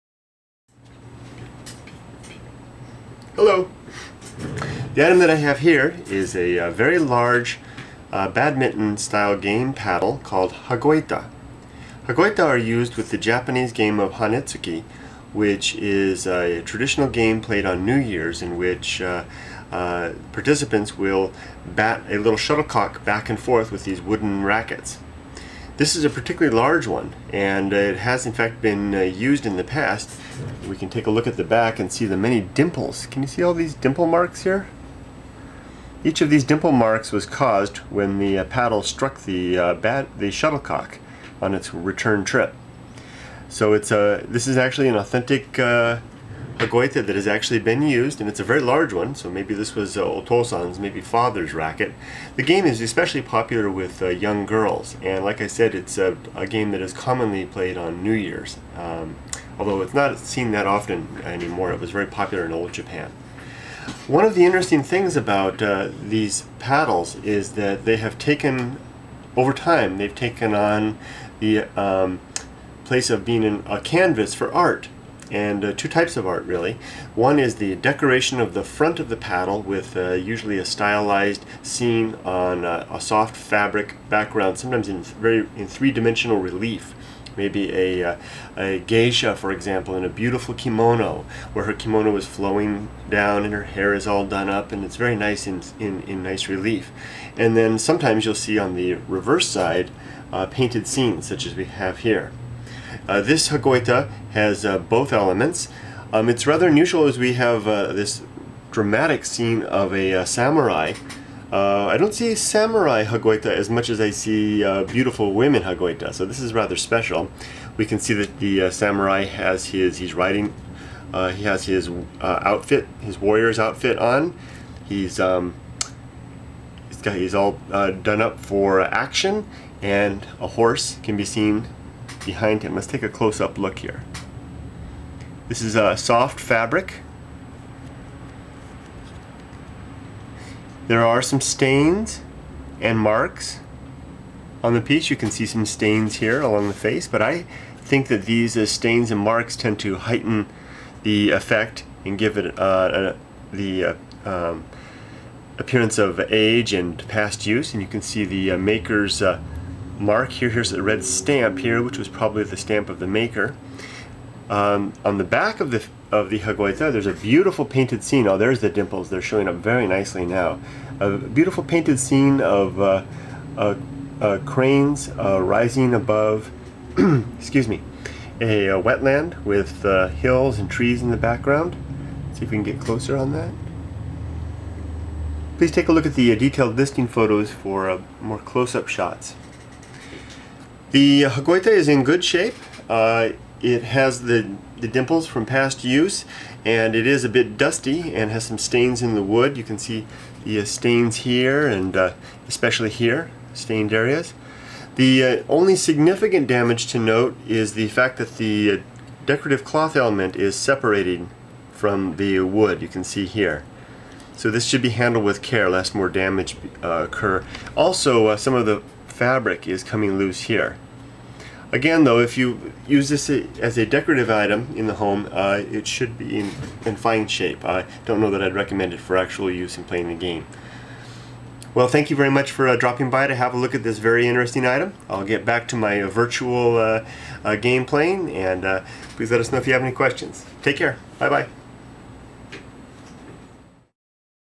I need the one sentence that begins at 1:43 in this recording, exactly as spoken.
Uh, this Hagoita has uh, both elements.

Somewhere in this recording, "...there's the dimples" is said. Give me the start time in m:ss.
2:48.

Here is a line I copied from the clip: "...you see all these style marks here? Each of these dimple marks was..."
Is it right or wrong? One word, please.
wrong.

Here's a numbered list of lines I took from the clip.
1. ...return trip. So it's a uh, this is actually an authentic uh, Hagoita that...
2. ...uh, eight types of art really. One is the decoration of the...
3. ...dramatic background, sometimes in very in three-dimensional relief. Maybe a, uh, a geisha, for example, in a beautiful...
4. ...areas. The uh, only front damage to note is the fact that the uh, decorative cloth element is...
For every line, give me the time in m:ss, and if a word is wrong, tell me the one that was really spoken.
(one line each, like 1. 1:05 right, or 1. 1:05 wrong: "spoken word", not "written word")
1. 0:41 right
2. 1:15 wrong: "two", not "eight"
3. 1:23 wrong: "fabric", not "dramatic"
4. 3:23 wrong: "significant", not "front".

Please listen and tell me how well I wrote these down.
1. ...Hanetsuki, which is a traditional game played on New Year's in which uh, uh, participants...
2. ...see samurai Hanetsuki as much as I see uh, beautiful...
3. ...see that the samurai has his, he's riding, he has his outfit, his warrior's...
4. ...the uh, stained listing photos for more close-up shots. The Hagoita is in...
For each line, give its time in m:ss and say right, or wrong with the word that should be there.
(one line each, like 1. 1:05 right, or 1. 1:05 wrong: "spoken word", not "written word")
1. 0:14 right
2. 1:52 wrong: "Hagoita", not "Hanetsuki"
3. 1:57 right
4. 3:06 wrong: "detailed", not "stained".